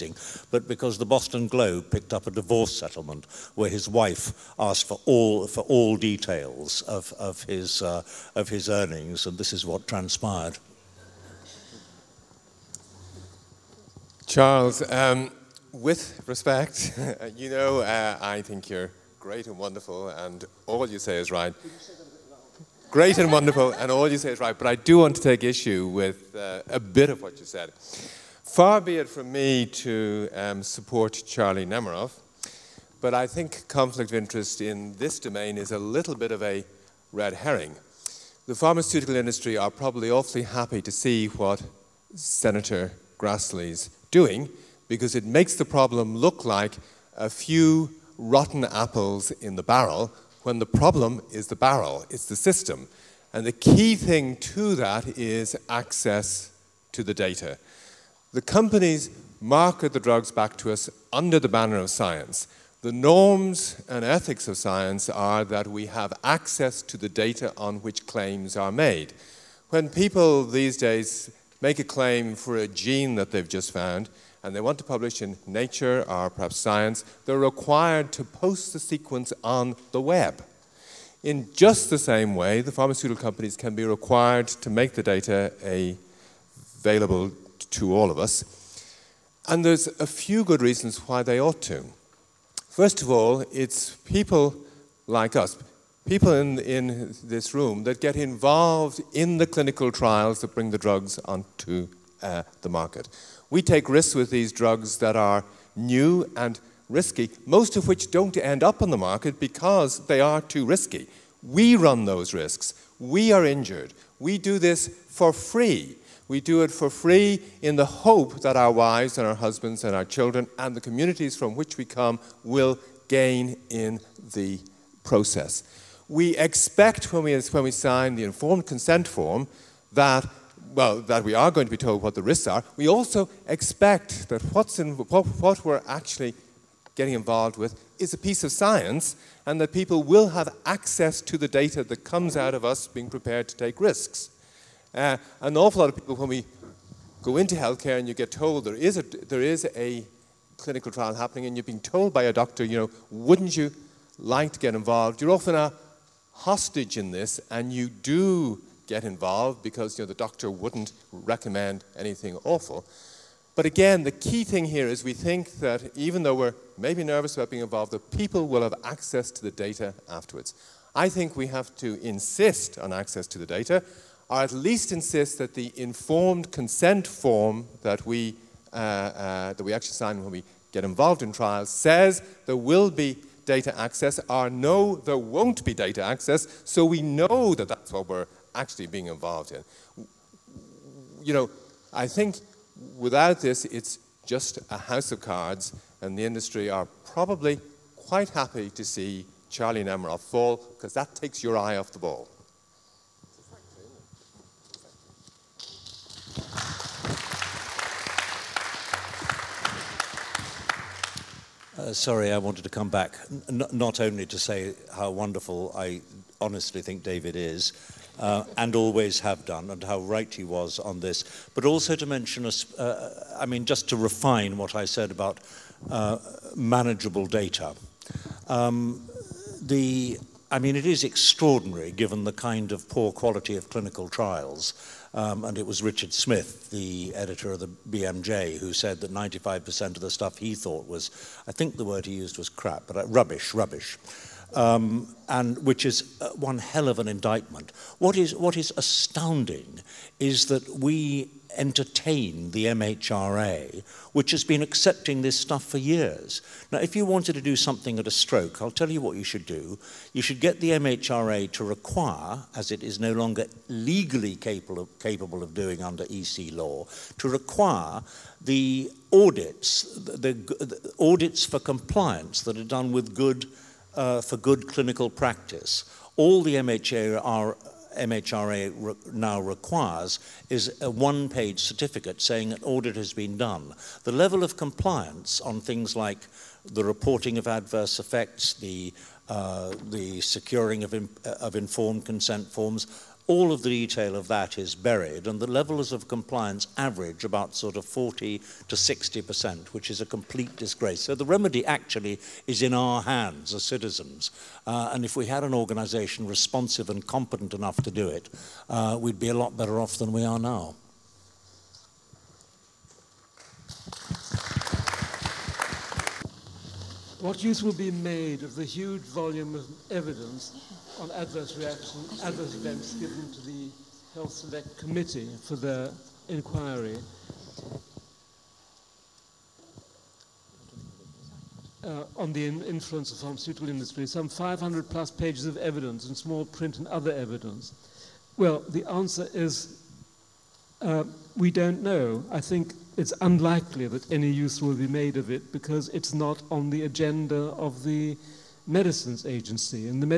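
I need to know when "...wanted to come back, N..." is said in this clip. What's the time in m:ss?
3:32.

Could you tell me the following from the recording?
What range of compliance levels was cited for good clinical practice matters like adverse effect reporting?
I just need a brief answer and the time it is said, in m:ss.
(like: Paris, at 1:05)
40 to 60%, at 4:57.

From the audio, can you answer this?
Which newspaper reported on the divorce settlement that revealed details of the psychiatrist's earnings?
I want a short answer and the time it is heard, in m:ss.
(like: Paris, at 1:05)
Boston Globe, at 0:01.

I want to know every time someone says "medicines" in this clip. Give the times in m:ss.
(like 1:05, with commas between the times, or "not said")
5:48.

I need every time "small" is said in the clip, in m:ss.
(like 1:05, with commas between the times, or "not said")
5:36.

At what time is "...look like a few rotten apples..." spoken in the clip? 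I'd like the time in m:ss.
0:46.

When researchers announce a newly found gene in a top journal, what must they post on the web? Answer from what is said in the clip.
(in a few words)
the sequence.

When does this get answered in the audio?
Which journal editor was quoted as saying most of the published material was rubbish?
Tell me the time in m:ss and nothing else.
3:55.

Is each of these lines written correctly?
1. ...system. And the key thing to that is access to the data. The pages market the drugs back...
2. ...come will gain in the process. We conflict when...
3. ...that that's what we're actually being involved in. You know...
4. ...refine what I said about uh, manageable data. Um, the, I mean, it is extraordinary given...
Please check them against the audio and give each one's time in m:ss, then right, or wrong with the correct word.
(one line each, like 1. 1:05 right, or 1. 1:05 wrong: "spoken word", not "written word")
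1. 0:52 wrong: "companies", not "pages"
2. 2:01 wrong: "expect", not "conflict"
3. 3:07 right
4. 3:43 right.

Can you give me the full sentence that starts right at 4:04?
Um, and which is uh, one hell of an indictment.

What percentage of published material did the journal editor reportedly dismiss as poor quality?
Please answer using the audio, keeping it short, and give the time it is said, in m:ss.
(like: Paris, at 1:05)
95%, at 3:59.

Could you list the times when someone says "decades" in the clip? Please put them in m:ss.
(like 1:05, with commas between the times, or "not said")
not said.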